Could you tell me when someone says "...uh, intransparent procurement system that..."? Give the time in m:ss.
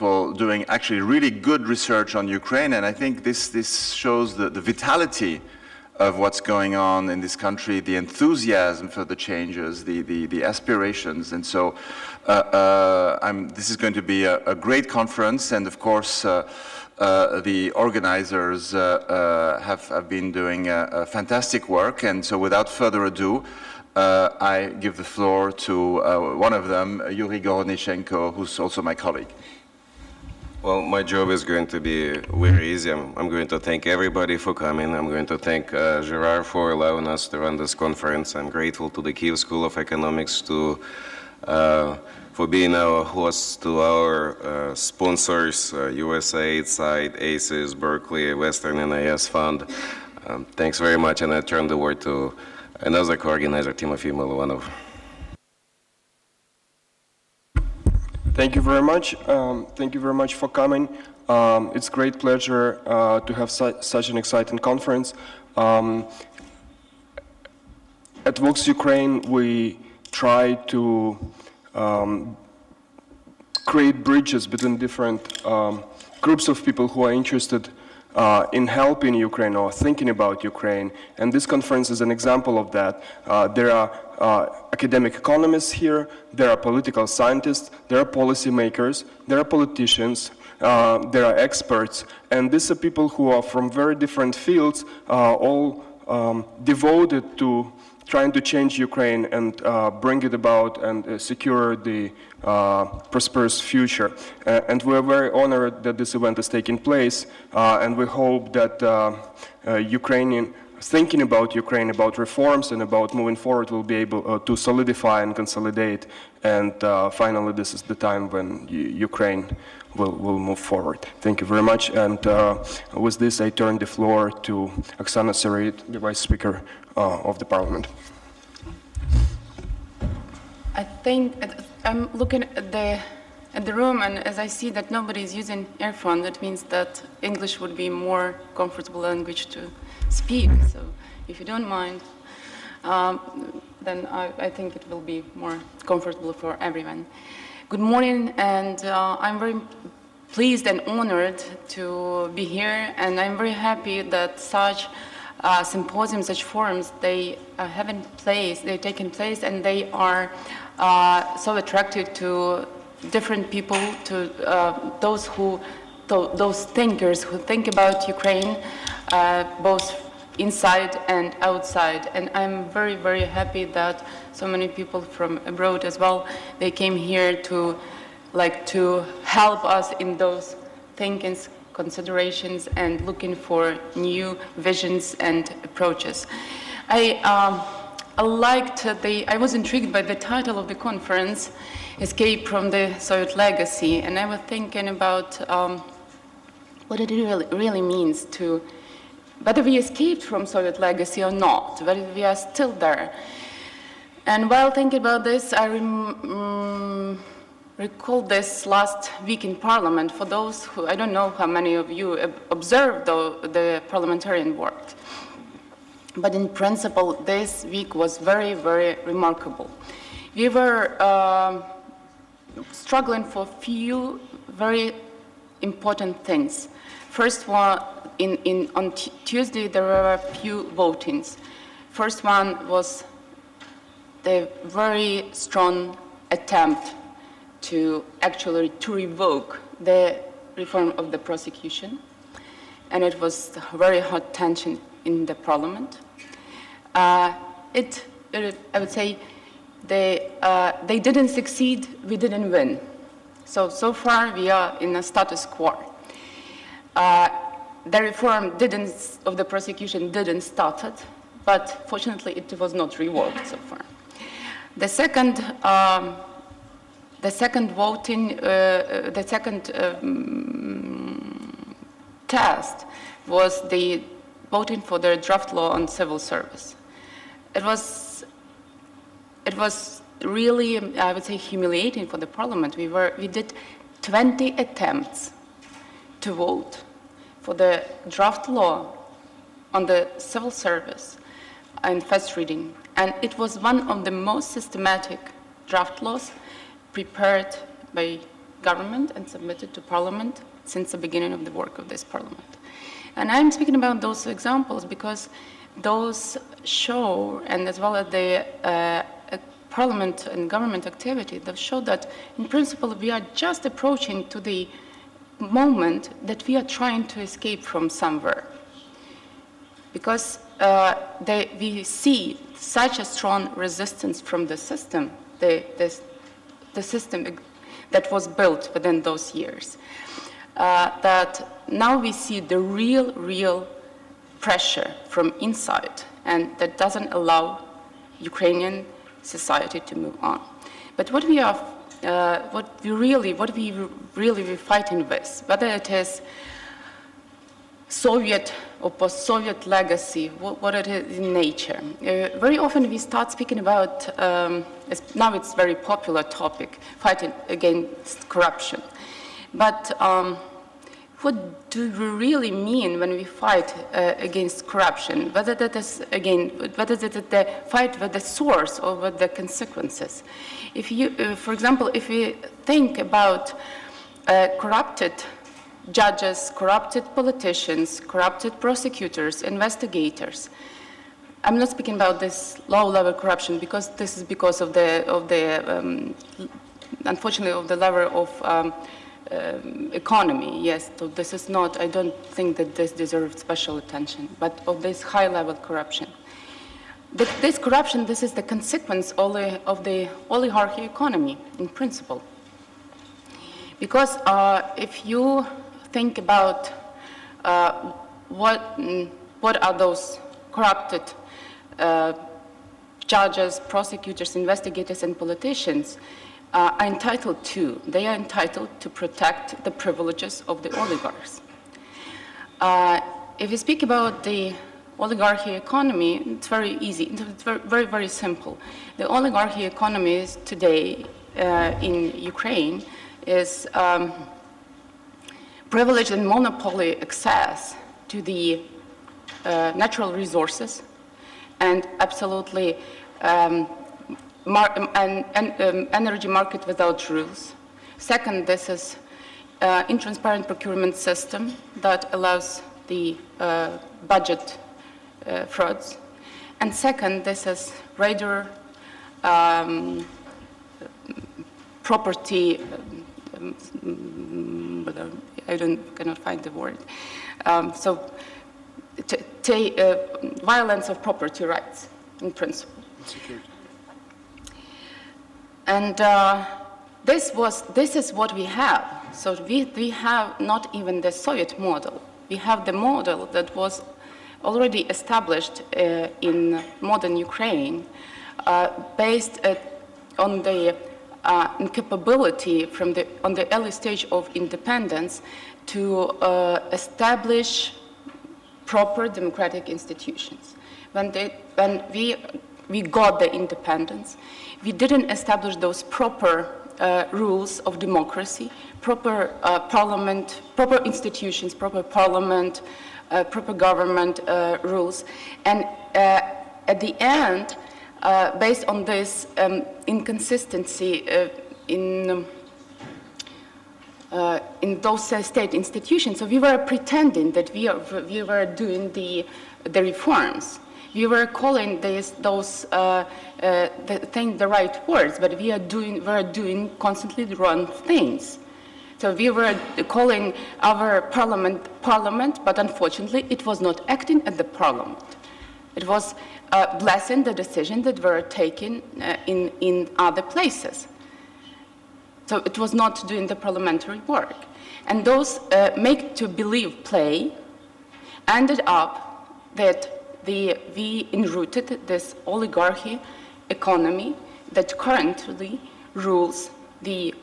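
7:29.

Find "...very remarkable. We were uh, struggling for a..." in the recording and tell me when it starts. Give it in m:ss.
3:38.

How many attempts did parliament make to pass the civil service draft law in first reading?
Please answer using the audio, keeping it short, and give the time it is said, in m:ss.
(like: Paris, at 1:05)
20, at 4:44.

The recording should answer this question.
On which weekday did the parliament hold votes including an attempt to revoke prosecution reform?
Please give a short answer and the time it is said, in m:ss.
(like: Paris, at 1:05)
Tuesday, at 3:49.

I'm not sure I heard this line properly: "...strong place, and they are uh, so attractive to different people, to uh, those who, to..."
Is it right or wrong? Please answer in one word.
wrong.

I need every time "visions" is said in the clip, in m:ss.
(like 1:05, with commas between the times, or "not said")
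3:04.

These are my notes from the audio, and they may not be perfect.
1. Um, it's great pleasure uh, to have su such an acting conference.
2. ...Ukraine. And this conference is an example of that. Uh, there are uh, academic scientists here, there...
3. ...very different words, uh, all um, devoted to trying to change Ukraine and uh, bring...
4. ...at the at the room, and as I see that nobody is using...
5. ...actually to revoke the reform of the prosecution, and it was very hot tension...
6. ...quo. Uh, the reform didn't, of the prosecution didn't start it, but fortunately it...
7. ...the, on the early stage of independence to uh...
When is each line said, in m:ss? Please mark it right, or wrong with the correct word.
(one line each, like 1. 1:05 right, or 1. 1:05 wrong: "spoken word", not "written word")
1. 1:01 wrong: "exciting", not "acting"
2. 1:20 wrong: "economists", not "scientists"
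3. 1:33 wrong: "fields", not "words"
4. 2:12 right
5. 3:58 right
6. 4:15 right
7. 8:12 right.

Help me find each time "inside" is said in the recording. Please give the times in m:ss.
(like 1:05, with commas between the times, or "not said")
2:50, 5:35.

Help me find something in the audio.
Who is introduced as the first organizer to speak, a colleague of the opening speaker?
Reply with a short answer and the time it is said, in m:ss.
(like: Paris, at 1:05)
Yuri Gorodnichenko, at 0:27.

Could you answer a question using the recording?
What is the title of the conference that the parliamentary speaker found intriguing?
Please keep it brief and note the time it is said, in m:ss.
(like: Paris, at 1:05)
Escape from the Soviet Legacy, at 3:12.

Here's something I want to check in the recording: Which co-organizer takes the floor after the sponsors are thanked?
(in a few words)
Tymofiy Mylovanov.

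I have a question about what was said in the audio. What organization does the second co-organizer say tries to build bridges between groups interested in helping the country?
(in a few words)
Vox Ukraine.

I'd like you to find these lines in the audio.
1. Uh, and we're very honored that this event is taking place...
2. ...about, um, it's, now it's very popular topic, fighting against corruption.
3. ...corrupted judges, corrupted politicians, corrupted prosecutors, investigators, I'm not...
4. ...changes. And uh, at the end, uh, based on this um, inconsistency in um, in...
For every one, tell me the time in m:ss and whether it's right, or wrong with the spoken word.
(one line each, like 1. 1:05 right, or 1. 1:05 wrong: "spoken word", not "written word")
1. 1:44 right
2. 5:53 right
3. 6:14 right
4. 8:34 wrong: "rules", not "changes".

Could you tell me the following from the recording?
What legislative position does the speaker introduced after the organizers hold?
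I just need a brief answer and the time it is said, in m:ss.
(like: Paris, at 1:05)
Vice Speaker, at 2:05.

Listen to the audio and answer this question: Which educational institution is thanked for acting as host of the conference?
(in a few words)
Kiev School of Economics.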